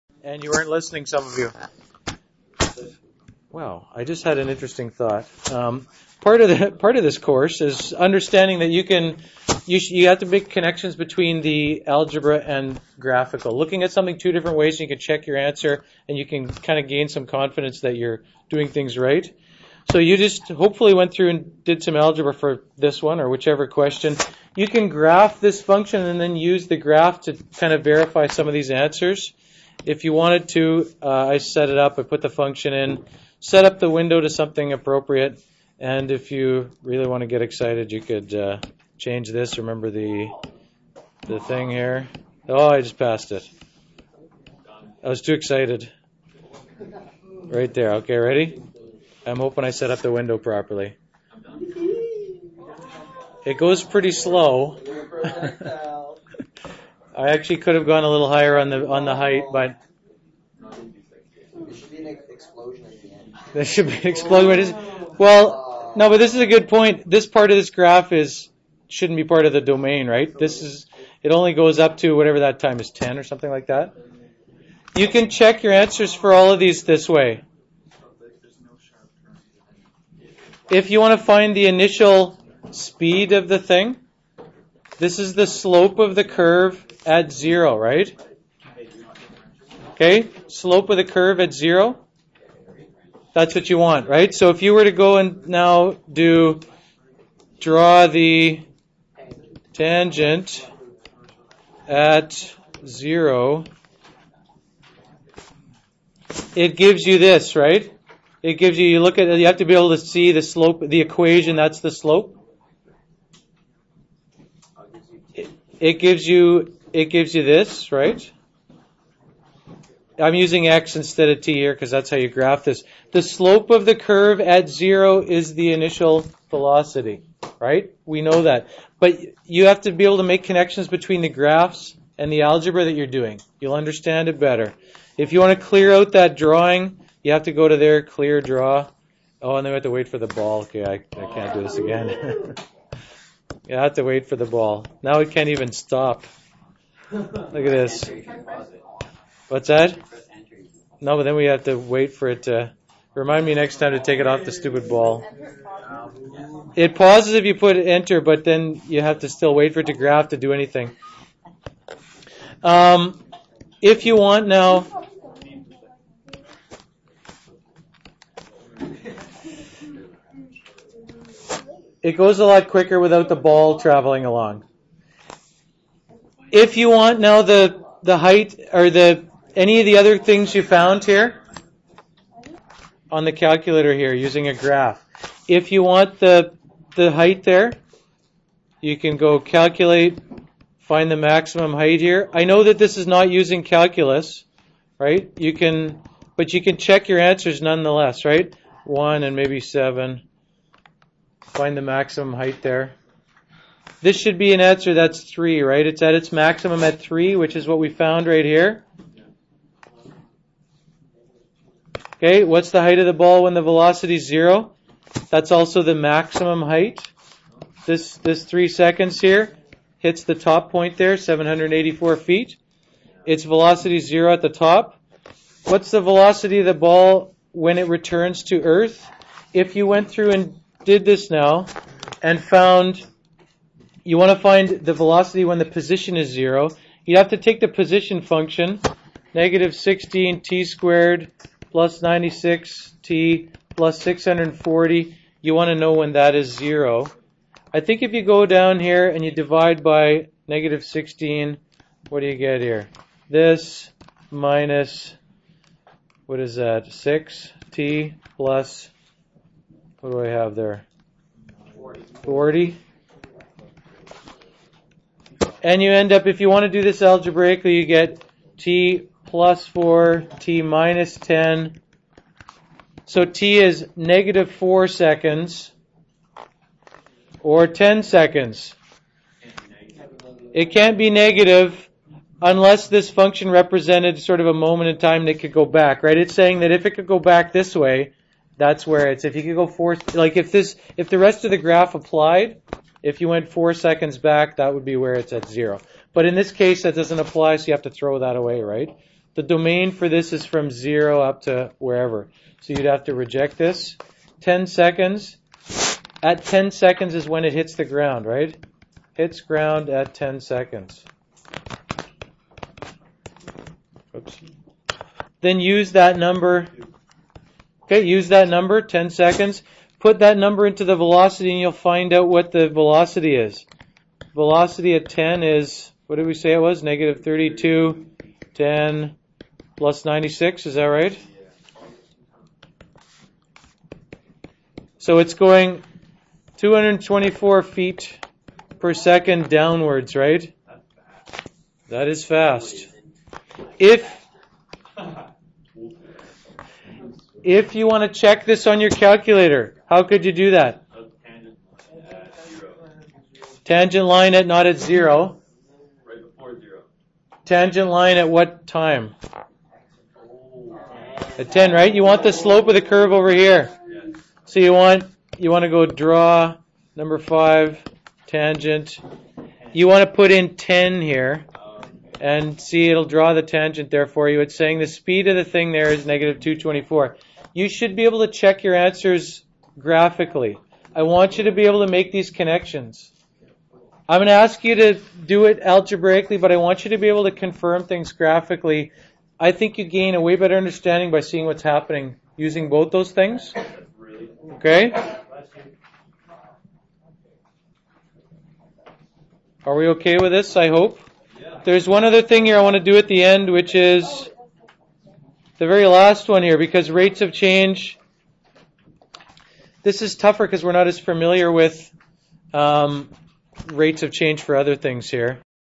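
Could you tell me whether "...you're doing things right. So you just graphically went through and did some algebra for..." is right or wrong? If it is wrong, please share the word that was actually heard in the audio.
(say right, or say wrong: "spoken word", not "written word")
wrong: "hopefully", not "graphically".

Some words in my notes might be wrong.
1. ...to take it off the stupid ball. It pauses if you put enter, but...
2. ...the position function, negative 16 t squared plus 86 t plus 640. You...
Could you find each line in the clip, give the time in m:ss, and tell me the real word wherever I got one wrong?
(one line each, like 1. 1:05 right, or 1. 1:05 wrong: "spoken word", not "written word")
1. 2:33 right
2. 3:57 wrong: "96", not "86".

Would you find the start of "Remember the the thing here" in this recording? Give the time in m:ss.
0:39.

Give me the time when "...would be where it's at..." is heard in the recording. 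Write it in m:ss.
4:54.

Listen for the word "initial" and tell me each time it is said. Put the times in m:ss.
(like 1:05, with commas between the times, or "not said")
1:21, 2:05.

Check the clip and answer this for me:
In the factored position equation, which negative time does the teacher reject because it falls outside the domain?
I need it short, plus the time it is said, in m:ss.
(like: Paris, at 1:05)
-4 seconds, at 4:33.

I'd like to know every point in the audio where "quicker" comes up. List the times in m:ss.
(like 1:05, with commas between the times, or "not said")
2:52.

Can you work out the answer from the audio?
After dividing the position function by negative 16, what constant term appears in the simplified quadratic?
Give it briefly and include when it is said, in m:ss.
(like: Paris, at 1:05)
40, at 4:22.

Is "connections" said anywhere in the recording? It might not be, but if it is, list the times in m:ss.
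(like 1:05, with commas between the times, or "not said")
0:10, 2:10, 6:22.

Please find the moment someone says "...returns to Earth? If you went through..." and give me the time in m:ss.
3:47.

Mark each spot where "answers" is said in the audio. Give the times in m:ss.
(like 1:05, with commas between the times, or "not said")
0:15, 0:28, 1:15, 3:17, 3:24, 6:18.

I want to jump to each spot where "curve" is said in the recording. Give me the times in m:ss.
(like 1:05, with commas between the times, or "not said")
1:26, 1:31, 2:03, 6:02.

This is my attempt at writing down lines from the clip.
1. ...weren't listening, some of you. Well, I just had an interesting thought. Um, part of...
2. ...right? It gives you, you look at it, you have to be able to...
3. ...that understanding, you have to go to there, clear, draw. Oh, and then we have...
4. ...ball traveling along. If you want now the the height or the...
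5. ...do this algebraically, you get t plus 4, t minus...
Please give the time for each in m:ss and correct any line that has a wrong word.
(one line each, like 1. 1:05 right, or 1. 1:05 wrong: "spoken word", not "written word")
1. 0:00 right
2. 1:47 right
3. 2:16 wrong: "drawing", not "understanding"
4. 2:53 right
5. 4:26 right.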